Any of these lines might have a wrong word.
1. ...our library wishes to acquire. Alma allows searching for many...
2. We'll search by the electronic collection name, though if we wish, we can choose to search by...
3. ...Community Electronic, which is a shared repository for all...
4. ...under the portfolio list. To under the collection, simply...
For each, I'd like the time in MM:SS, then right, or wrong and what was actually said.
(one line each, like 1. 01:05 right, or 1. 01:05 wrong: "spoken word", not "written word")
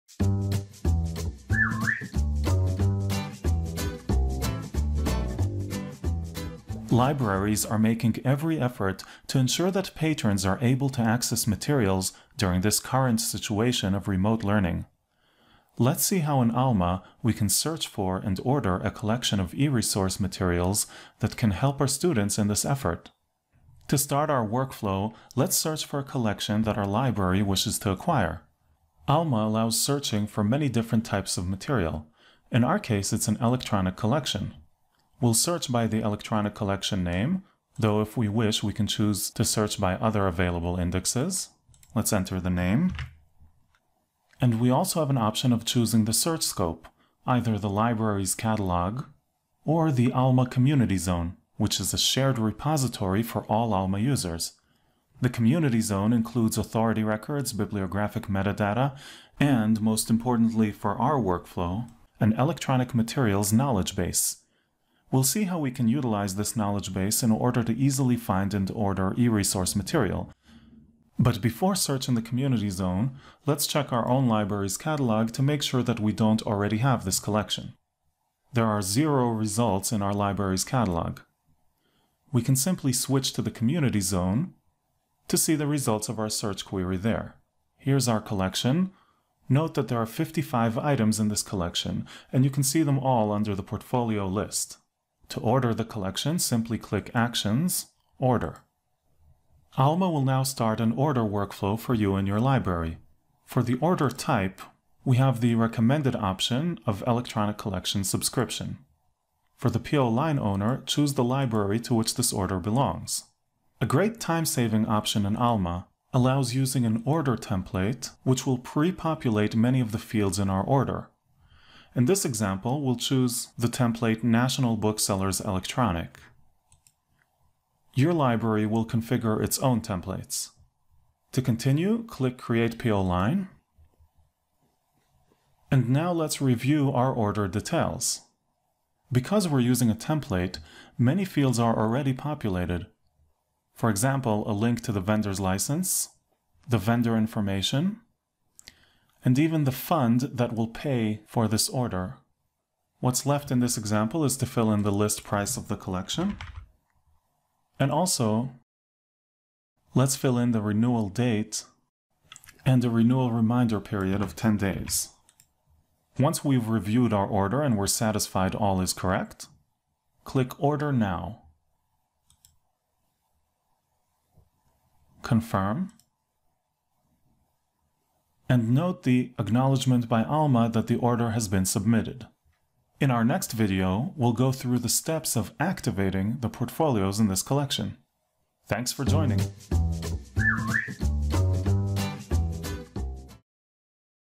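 1. 00:26 right
2. 00:35 right
3. 00:50 wrong: "Zone", not "Electronic"
4. 01:33 wrong: "order", not "under".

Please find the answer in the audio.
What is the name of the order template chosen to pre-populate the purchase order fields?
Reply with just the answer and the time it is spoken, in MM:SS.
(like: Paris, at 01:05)
National Booksellers Electronic, at 02:04.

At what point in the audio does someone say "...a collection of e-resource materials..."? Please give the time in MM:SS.
00:18.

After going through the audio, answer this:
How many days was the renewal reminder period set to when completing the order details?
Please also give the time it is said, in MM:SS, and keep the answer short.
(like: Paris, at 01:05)
10, at 02:44.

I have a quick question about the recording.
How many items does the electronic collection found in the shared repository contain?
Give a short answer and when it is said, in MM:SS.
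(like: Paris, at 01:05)
55, at 01:30.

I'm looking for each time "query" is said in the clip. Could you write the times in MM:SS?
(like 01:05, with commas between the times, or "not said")
01:26.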